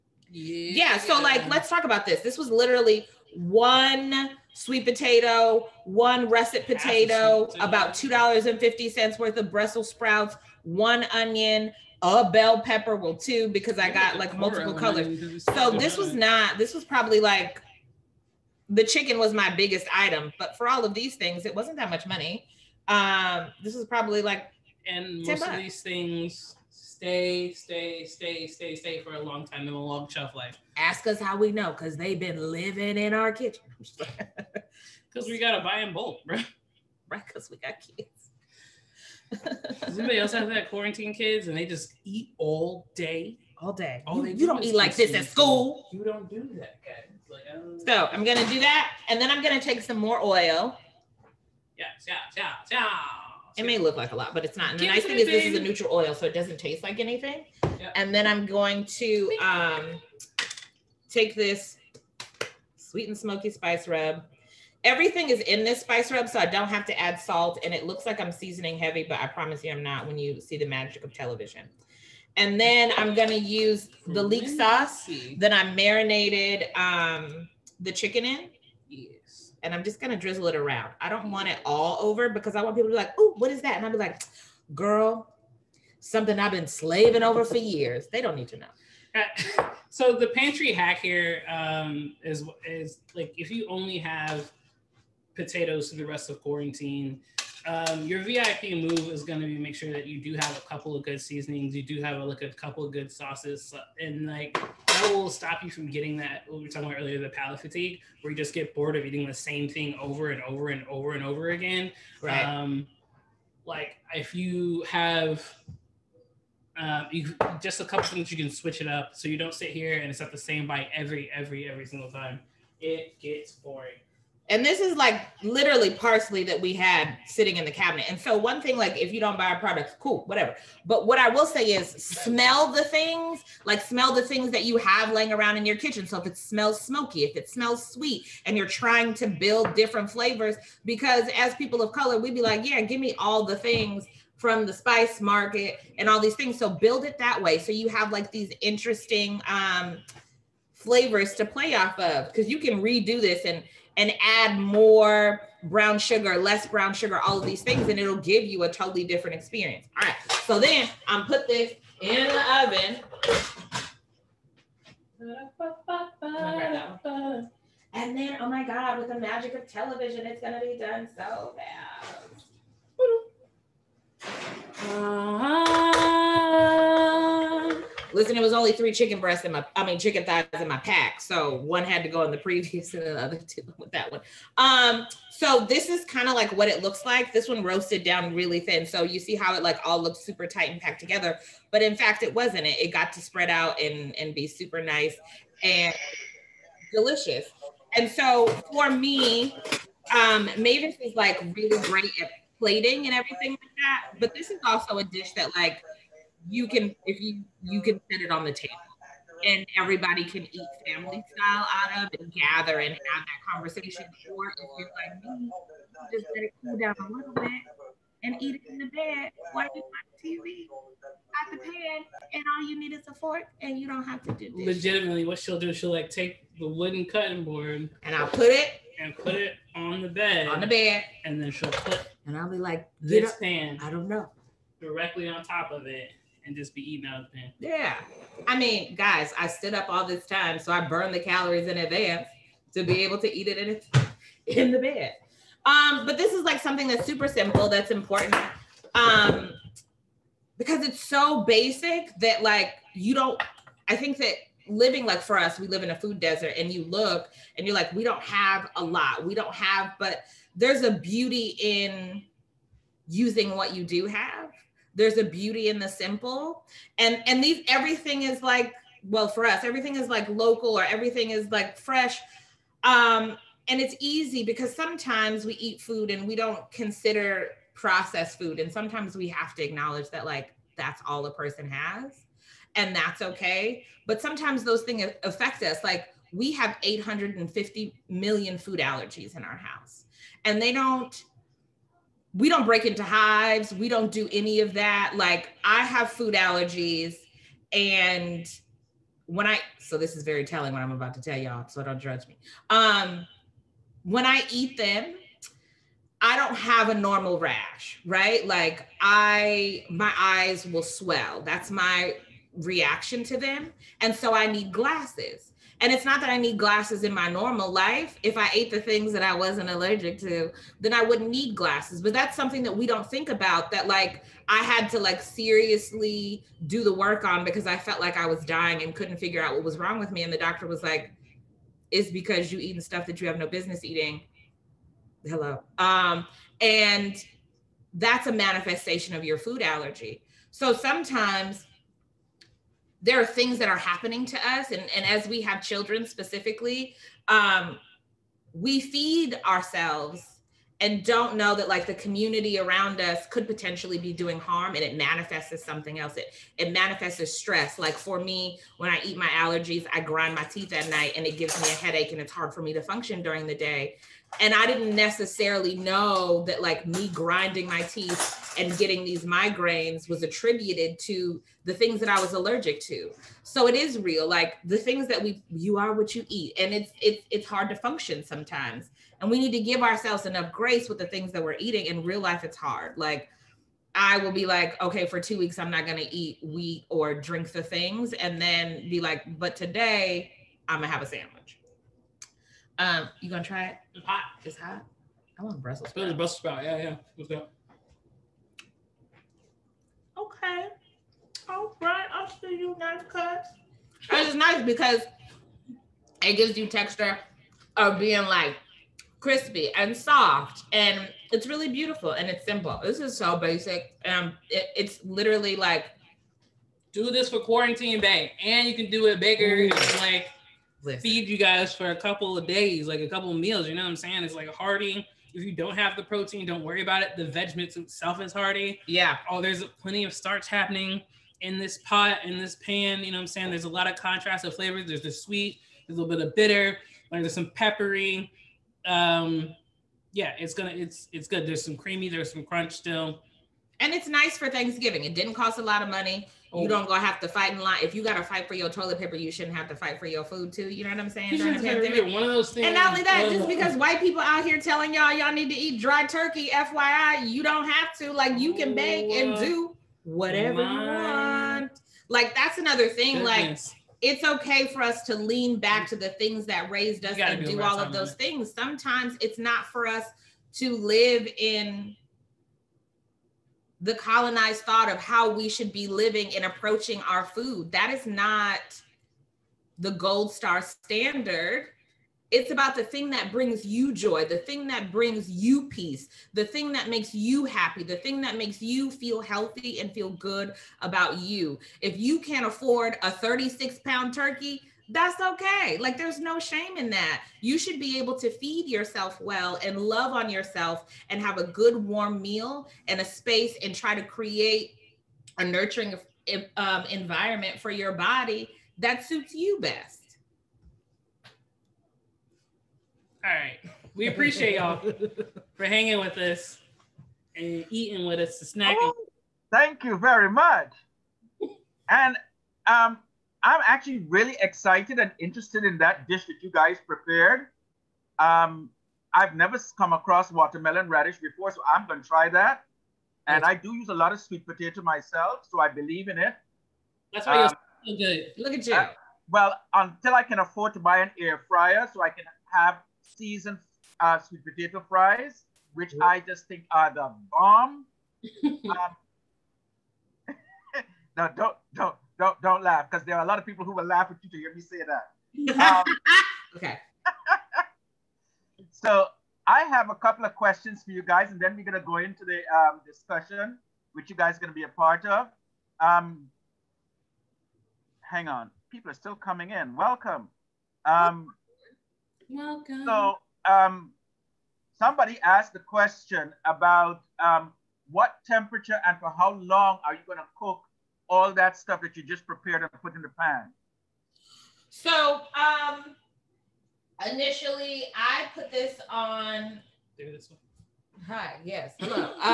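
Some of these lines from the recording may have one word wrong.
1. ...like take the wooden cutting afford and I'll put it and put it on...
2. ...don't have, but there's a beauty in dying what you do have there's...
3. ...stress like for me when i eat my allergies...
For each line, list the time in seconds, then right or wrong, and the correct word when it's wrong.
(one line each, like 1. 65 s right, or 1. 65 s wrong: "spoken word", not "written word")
1. 225 s wrong: "board", not "afford"
2. 259 s wrong: "using", not "dying"
3. 357 s right.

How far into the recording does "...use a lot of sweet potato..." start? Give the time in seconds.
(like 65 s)
533 s.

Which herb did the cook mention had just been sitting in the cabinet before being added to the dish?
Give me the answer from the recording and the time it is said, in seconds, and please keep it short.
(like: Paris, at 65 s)
parsley, at 125 s.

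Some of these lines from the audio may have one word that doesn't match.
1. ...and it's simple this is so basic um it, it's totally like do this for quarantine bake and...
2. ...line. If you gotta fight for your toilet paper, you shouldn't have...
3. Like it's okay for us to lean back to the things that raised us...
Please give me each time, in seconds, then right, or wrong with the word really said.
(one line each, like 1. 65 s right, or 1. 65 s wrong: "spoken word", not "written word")
1. 412 s wrong: "literally", not "totally"
2. 447 s right
3. 463 s right.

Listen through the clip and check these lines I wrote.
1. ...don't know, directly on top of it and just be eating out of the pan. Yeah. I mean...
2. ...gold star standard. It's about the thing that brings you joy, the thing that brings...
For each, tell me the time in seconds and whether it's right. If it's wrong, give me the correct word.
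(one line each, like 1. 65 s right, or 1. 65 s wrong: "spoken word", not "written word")
1. 233 s right
2. 479 s right.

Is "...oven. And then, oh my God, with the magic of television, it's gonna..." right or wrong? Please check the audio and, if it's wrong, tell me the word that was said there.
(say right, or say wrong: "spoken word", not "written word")
right.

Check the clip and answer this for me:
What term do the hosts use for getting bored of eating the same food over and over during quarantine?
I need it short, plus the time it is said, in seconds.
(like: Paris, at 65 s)
palate fatigue, at 107 s.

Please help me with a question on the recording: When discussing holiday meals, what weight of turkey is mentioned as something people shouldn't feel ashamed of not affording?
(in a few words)
36 pounds.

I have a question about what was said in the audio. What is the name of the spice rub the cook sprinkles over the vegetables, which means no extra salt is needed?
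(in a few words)
sweet and smoky.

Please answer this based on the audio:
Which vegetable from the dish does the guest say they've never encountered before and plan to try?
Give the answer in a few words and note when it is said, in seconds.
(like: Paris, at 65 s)
watermelon radish, at 530 s.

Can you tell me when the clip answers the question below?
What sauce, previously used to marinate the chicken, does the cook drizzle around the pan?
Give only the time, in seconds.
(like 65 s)
74 s.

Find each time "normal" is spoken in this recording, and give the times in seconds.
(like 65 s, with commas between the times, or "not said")
306 s, 317 s.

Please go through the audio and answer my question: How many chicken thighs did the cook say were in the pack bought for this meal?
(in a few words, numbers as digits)
3.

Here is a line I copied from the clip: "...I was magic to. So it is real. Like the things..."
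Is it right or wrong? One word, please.
wrong.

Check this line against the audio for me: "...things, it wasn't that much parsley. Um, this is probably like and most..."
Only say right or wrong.
wrong.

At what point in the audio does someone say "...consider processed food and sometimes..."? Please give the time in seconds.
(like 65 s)
276 s.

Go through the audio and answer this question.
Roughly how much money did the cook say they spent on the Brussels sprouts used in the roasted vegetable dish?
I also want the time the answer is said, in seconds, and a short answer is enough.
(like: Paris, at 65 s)
$2.50, at 7 s.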